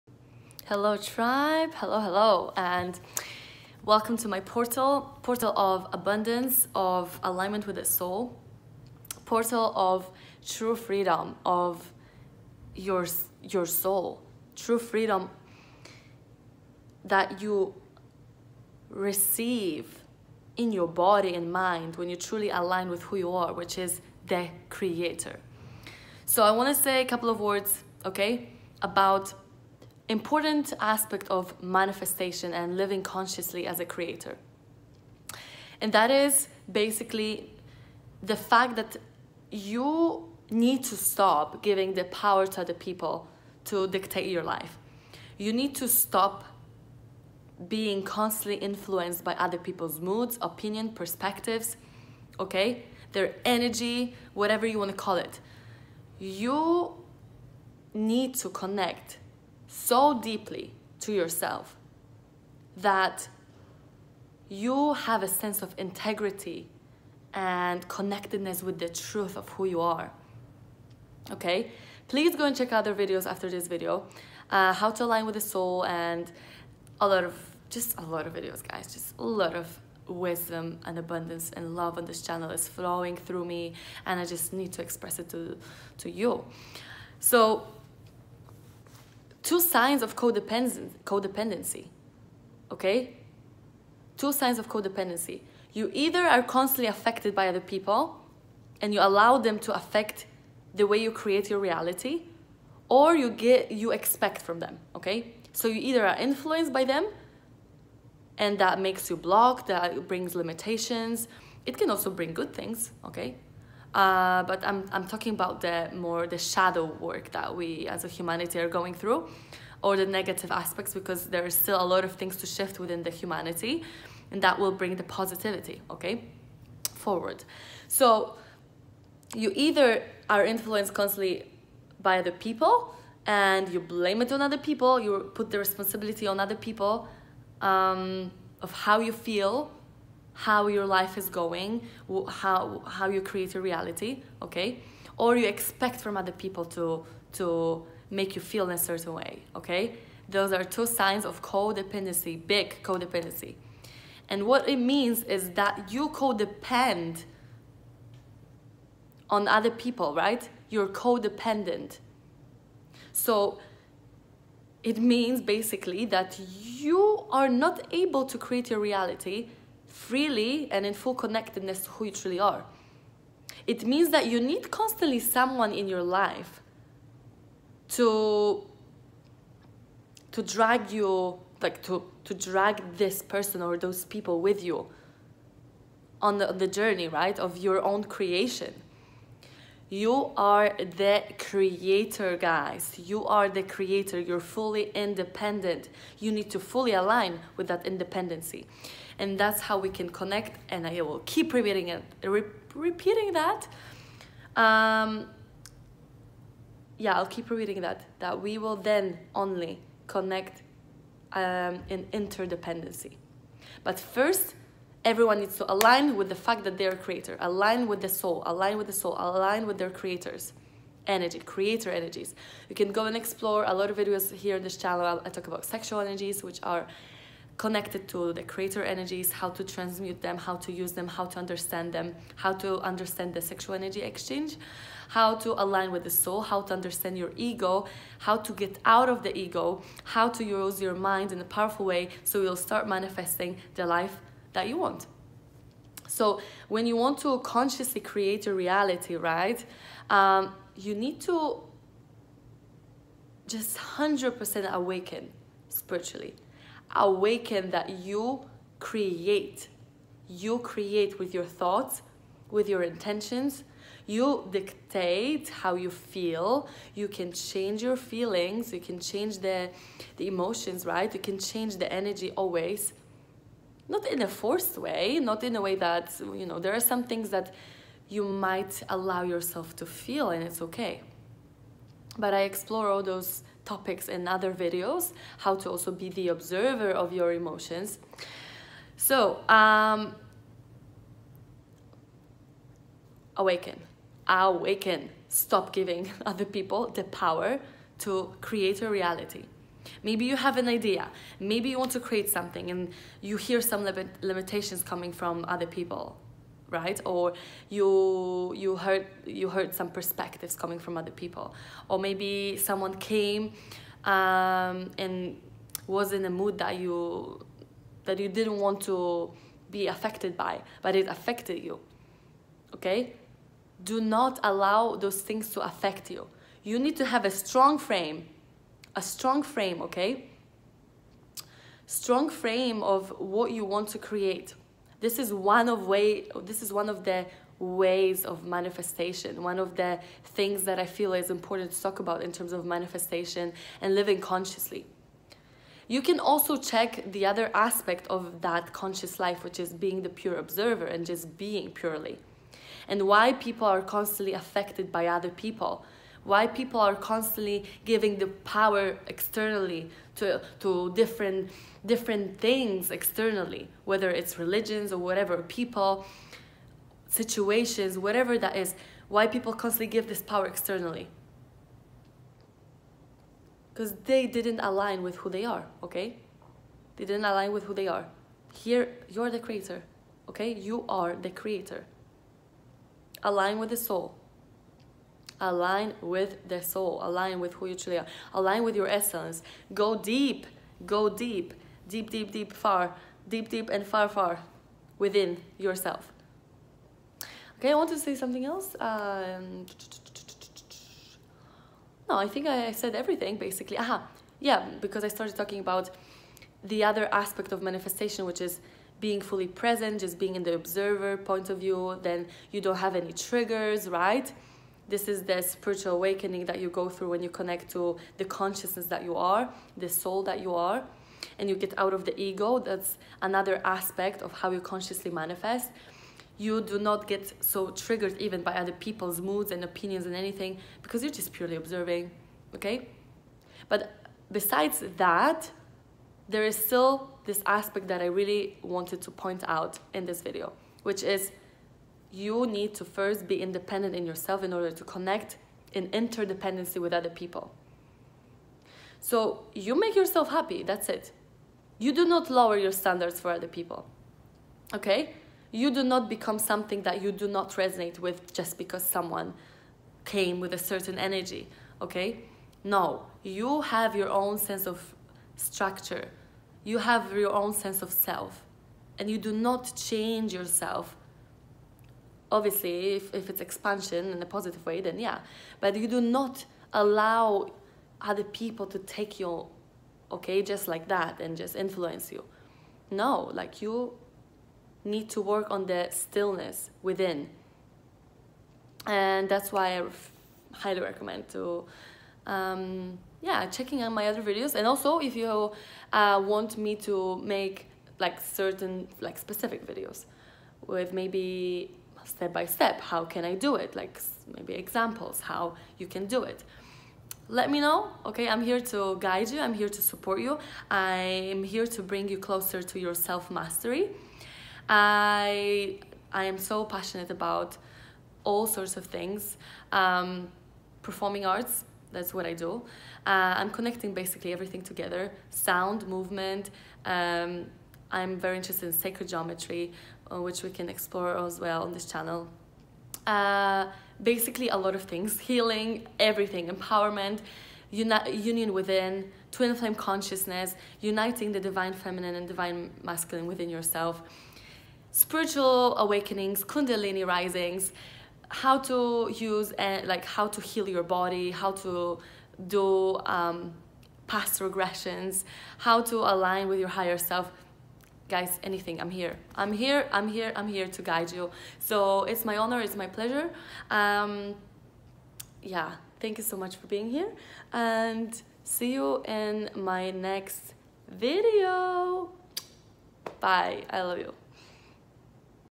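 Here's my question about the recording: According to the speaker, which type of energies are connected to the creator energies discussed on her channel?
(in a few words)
sexual energies.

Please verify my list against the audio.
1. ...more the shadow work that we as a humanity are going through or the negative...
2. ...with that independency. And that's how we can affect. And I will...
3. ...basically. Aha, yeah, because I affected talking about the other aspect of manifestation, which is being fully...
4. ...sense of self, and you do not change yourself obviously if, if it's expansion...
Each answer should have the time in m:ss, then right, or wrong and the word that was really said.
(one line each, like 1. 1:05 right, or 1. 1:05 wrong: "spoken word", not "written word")
1. 1:55 right
2. 3:17 wrong: "connect", not "affect"
3. 6:43 wrong: "started", not "affected"
4. 7:47 right.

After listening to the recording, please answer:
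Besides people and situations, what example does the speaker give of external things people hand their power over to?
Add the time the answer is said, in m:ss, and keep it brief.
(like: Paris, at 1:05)
religions, at 6:04.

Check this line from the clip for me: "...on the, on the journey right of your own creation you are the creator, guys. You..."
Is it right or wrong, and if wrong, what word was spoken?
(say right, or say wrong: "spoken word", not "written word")
right.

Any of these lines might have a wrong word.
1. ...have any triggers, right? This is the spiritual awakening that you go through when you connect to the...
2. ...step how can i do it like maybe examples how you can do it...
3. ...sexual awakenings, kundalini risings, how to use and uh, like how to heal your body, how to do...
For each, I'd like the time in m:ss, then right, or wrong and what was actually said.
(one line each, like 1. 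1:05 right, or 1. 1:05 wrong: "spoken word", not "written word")
1. 6:52 right
2. 8:22 right
3. 9:04 wrong: "spiritual", not "sexual".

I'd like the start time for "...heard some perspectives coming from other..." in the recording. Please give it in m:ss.
5:09.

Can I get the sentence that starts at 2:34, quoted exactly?
And what it means is that you codepend on other people, right?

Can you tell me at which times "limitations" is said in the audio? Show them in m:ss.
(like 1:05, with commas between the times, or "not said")
1:50, 5:04.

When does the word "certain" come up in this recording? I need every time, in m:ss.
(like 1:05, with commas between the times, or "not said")
2:28, 7:40, 8:18.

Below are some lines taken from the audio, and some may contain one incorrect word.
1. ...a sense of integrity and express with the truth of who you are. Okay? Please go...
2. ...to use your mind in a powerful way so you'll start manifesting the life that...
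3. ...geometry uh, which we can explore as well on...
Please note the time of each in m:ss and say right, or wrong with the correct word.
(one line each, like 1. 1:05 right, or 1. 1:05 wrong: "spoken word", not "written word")
1. 1:05 wrong: "connectedness", not "express"
2. 4:00 right
3. 8:49 right.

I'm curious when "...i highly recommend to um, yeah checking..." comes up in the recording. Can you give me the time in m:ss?
8:09.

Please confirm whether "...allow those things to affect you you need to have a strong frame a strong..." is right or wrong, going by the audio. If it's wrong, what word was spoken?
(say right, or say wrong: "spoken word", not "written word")
right.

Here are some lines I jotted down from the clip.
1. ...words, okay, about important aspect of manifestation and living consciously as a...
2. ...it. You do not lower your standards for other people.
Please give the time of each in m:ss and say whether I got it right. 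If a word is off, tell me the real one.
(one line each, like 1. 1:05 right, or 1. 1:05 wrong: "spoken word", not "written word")
1. 0:27 right
2. 7:30 right.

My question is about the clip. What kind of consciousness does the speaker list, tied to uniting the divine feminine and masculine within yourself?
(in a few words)
twin flame consciousness.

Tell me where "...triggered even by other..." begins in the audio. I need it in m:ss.
7:07.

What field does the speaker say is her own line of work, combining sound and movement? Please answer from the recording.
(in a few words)
performing arts.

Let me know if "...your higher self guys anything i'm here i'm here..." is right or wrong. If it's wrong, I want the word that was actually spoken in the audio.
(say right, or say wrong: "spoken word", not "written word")
right.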